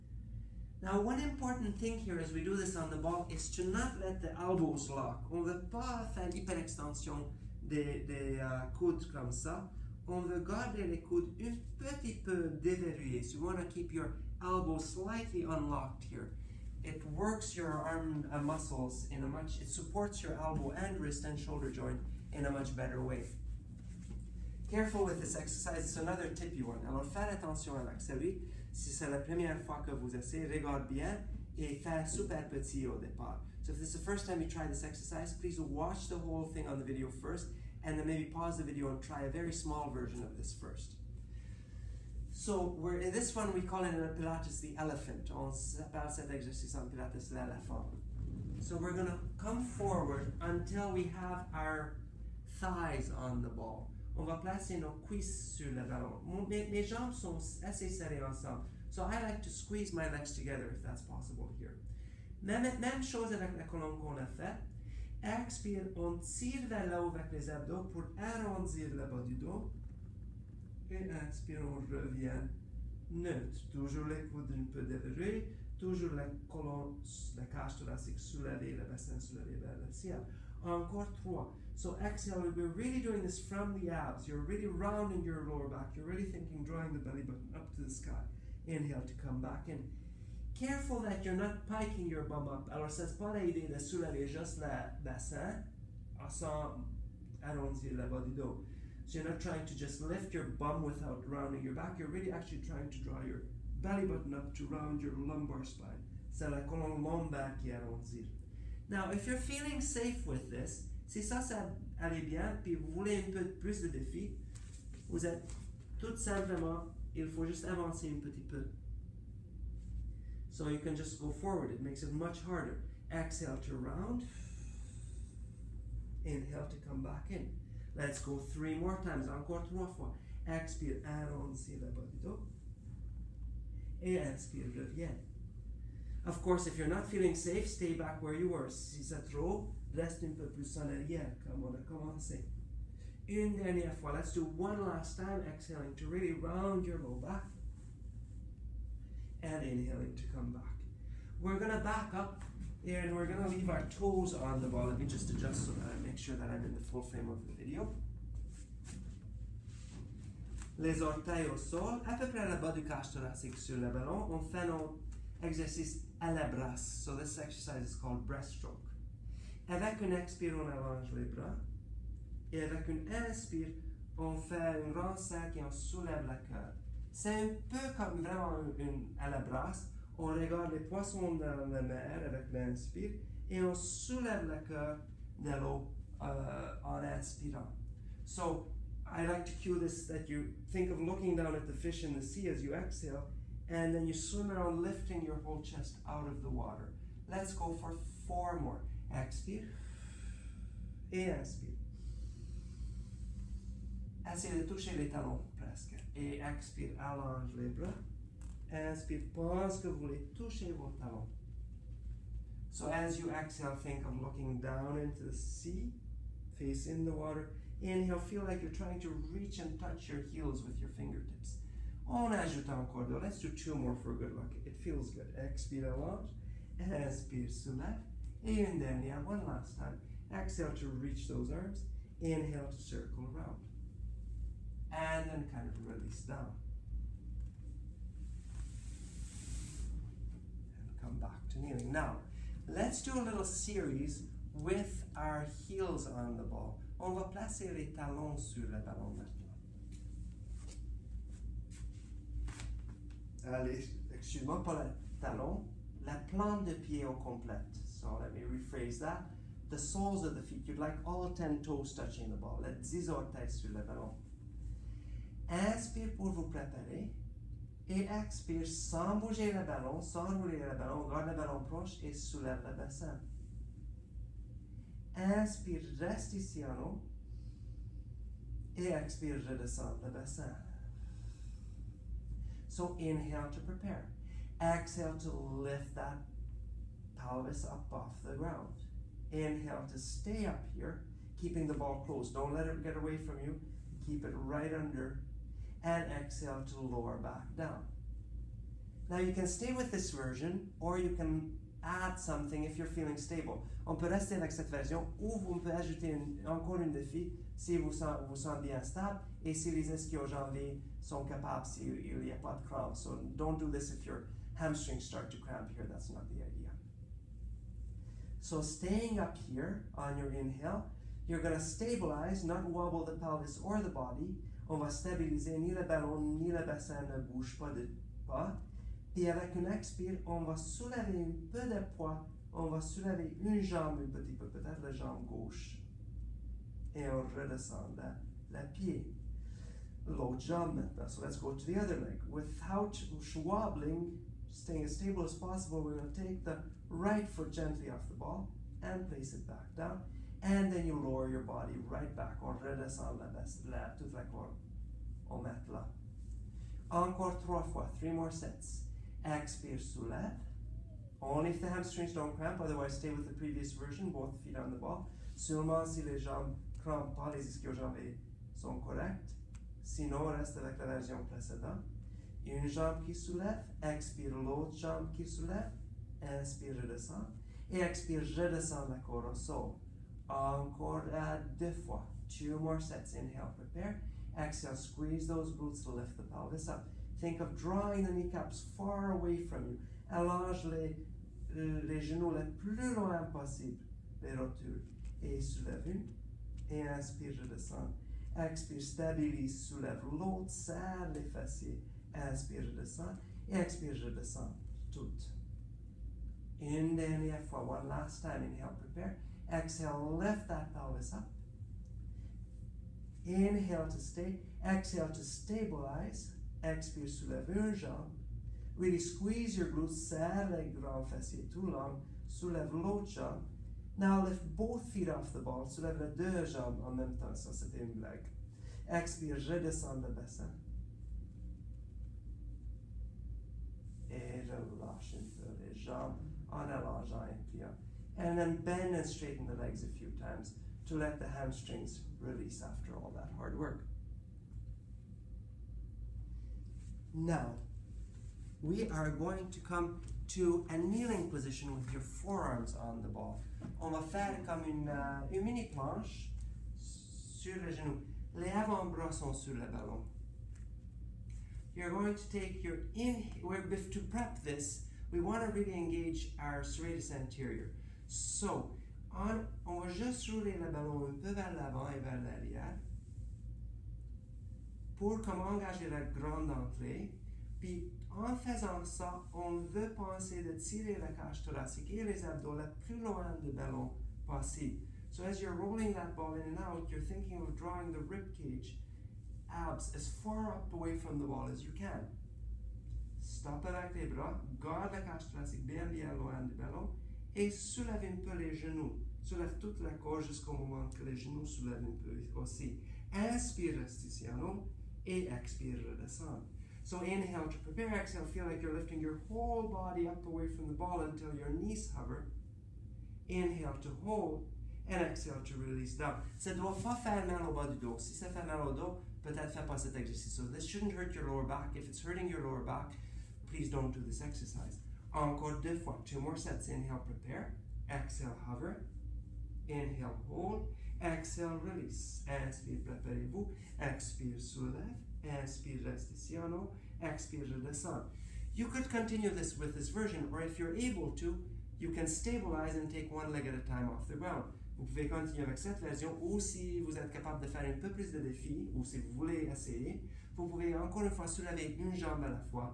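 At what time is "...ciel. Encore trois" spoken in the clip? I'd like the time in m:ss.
1:19.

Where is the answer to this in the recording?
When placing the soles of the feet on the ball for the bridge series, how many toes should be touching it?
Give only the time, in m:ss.
4:21.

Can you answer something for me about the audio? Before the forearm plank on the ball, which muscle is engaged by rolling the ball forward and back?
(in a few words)
Serratus anterior.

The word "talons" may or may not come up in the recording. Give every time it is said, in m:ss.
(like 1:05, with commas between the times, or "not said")
3:25, 3:30, 4:07, 4:15.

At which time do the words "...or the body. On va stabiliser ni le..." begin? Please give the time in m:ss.
5:23.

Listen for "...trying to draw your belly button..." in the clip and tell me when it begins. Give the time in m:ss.
1:42.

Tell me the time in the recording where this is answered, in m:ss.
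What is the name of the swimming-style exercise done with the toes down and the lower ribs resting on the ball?
2:48.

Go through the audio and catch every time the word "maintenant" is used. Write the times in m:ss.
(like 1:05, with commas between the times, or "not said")
4:09, 5:40.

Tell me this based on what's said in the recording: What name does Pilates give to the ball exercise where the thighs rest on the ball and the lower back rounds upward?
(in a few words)
The elephant.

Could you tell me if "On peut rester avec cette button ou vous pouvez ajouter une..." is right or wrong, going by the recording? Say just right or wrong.
wrong.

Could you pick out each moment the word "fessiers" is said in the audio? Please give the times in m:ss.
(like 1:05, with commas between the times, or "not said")
6:41, 7:01.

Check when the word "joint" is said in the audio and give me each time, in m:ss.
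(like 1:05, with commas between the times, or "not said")
0:21.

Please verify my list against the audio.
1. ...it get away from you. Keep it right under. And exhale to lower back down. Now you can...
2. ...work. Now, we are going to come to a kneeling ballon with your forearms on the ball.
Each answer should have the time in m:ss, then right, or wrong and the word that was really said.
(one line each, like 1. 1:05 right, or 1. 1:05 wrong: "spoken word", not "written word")
1. 4:52 right
2. 7:23 wrong: "position", not "ballon".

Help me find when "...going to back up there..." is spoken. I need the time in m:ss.
2:31.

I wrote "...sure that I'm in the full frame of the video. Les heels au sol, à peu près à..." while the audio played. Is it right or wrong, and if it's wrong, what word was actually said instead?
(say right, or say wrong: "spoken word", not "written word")
wrong: "orteils", not "heels".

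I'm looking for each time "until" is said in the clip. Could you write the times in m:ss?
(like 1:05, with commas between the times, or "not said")
0:50, 8:31.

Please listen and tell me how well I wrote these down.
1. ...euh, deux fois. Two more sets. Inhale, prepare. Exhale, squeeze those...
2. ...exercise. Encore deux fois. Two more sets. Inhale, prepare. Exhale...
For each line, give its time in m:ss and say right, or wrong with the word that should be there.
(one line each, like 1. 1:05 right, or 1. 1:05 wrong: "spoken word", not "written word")
1. 6:21 right
2. 8:44 right.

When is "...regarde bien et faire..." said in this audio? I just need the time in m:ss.
0:30.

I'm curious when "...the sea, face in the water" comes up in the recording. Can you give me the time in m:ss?
3:35.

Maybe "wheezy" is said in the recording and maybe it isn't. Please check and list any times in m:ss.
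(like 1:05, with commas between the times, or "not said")
not said.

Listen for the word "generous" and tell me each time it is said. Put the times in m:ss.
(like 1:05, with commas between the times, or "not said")
not said.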